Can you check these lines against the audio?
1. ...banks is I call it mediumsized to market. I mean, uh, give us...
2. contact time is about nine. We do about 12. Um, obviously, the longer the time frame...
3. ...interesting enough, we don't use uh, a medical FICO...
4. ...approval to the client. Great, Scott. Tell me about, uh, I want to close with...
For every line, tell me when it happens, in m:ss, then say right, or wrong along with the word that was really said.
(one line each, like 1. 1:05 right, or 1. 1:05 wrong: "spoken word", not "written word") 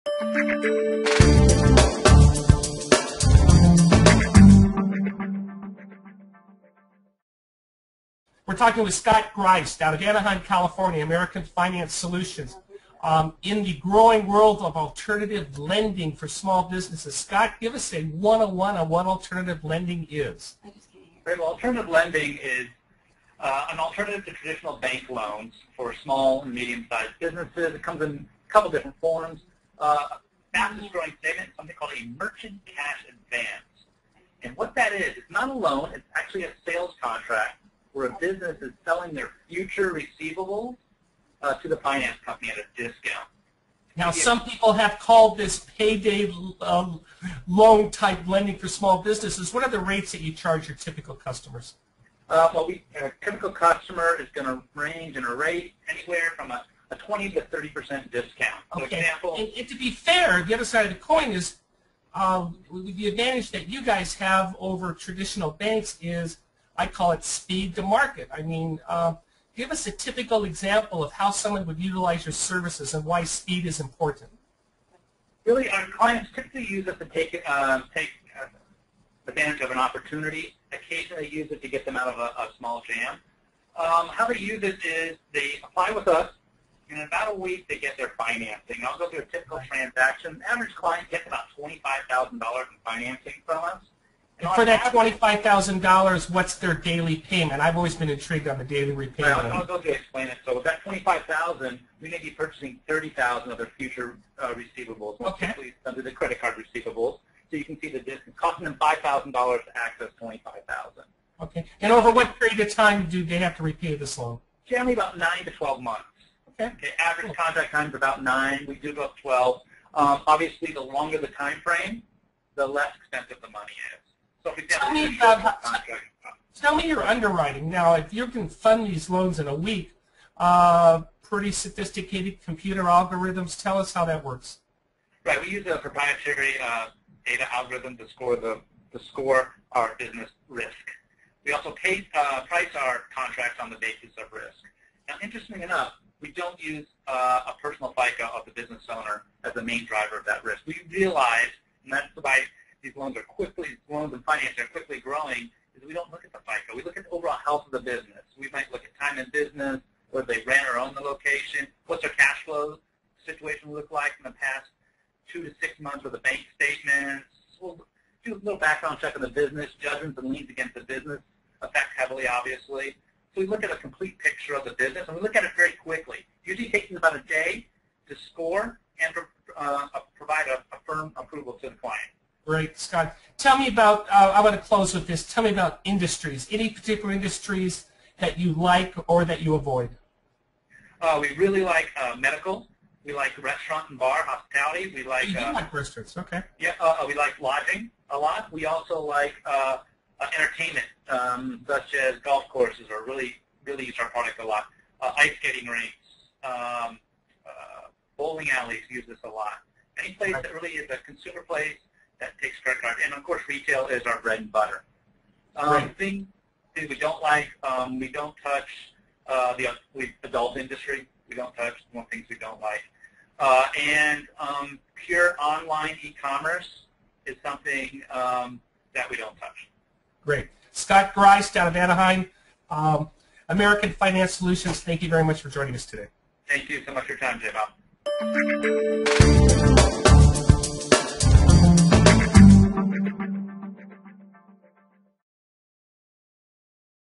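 1. 1:05 wrong: "speed", not "mediumsized"
2. 1:57 right
3. 2:25 wrong: "personal", not "medical"
4. 3:01 right.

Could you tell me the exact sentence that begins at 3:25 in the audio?
Uh, ice skating rinks, um, uh, bowling alleys use this a lot.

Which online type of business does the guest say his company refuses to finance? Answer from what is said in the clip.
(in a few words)
Pure online e-commerce.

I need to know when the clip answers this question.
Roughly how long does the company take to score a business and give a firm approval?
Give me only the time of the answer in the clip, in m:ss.
2:56.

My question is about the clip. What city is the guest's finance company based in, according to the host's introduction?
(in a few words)
Anaheim, California.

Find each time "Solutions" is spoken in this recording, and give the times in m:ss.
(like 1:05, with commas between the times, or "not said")
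0:11, 3:54.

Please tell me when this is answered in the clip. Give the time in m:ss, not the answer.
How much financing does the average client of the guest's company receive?
1:31.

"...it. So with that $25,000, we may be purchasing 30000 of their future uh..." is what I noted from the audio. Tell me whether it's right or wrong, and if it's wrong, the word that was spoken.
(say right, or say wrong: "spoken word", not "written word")
right.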